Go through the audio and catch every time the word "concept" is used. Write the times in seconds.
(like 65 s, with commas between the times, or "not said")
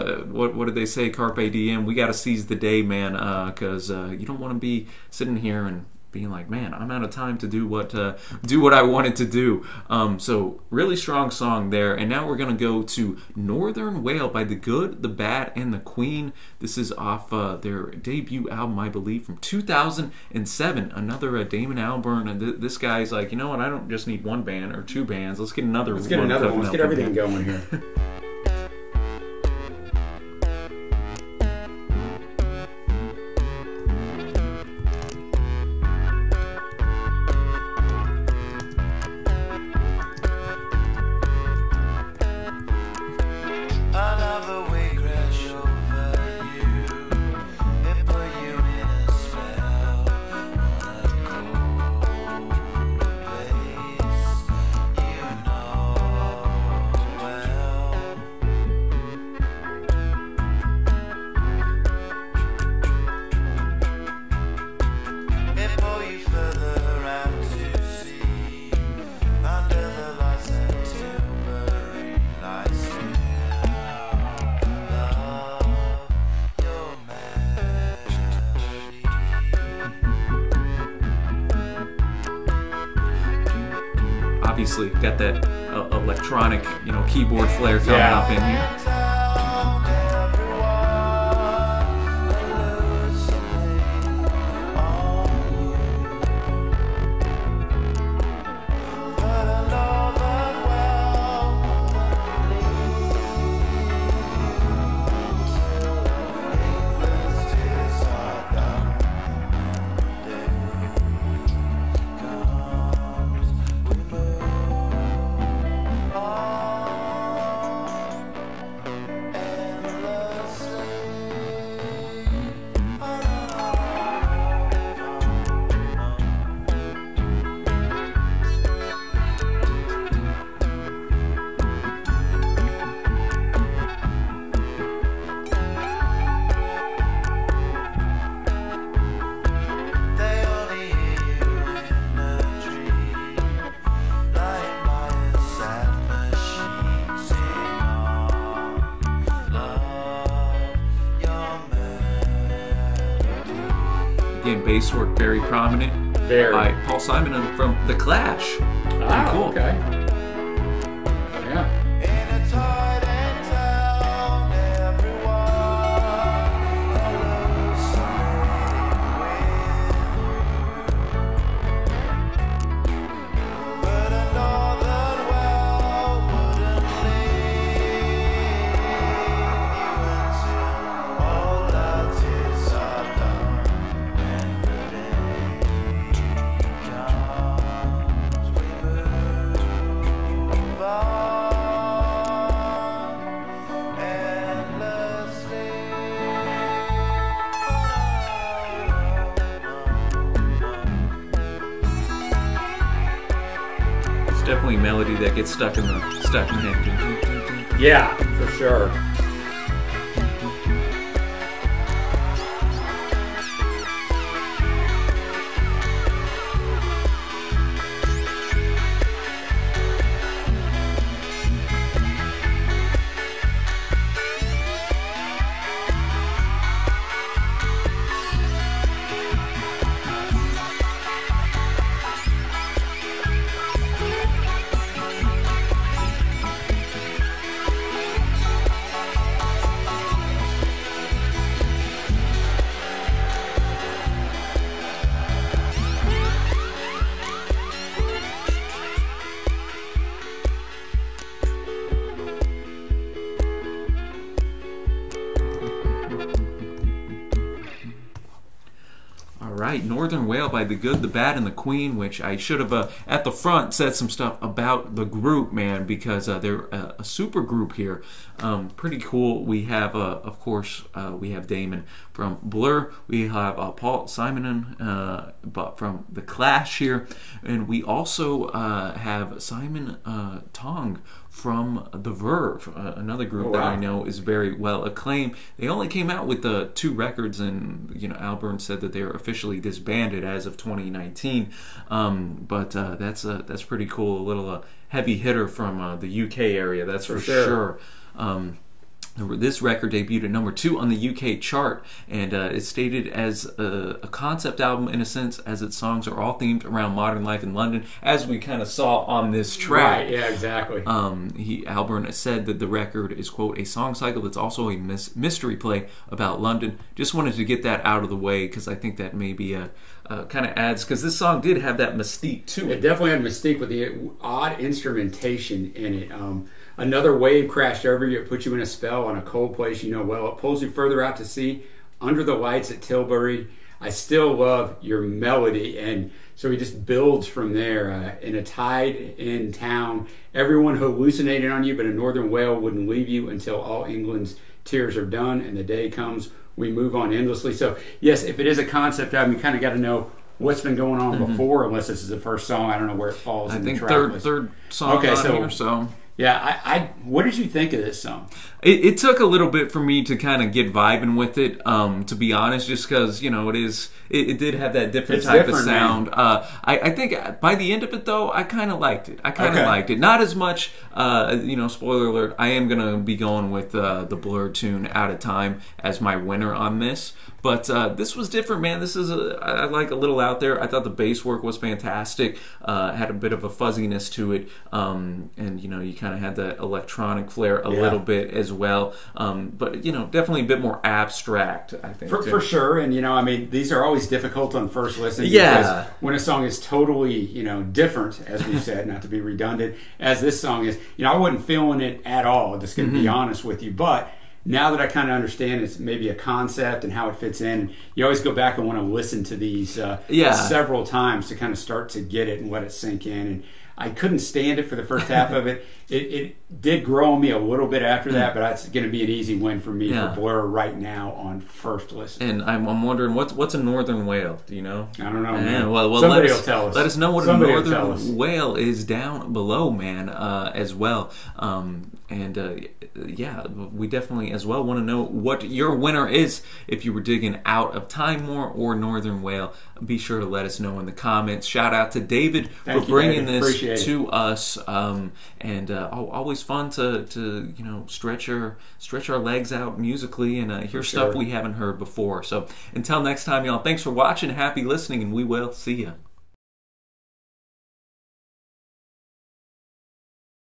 304 s, 348 s, 406 s.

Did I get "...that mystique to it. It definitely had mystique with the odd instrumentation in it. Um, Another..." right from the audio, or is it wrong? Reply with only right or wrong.
right.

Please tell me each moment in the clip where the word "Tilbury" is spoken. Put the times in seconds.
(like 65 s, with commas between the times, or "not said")
332 s.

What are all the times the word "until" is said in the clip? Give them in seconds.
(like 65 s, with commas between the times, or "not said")
343 s, 452 s.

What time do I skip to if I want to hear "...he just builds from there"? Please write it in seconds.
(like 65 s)
336 s.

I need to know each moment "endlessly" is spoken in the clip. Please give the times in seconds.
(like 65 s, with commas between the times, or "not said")
347 s.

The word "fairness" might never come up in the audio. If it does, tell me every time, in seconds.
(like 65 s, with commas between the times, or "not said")
not said.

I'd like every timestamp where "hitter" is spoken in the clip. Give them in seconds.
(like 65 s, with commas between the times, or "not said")
295 s.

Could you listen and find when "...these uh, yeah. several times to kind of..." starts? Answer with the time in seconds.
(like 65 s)
409 s.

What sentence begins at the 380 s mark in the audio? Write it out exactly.
I thought the bass work was fantastic.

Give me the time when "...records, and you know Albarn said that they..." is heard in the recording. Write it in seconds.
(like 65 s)
286 s.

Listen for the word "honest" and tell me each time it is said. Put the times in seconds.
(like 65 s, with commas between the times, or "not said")
362 s, 403 s.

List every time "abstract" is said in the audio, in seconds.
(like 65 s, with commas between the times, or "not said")
390 s.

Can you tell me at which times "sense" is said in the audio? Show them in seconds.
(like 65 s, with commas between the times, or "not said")
305 s.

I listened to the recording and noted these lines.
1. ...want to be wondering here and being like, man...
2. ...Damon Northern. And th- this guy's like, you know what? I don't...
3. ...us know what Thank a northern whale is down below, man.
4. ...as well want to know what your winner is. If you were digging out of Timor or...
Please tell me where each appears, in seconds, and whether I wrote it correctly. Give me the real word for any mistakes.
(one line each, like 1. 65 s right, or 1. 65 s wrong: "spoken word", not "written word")
1. 4 s wrong: "sitting", not "wondering"
2. 21 s wrong: "Albarn", not "Northern"
3. 426 s wrong: "Somebody", not "Thank"
4. 434 s right.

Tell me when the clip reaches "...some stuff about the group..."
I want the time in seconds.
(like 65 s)
263 s.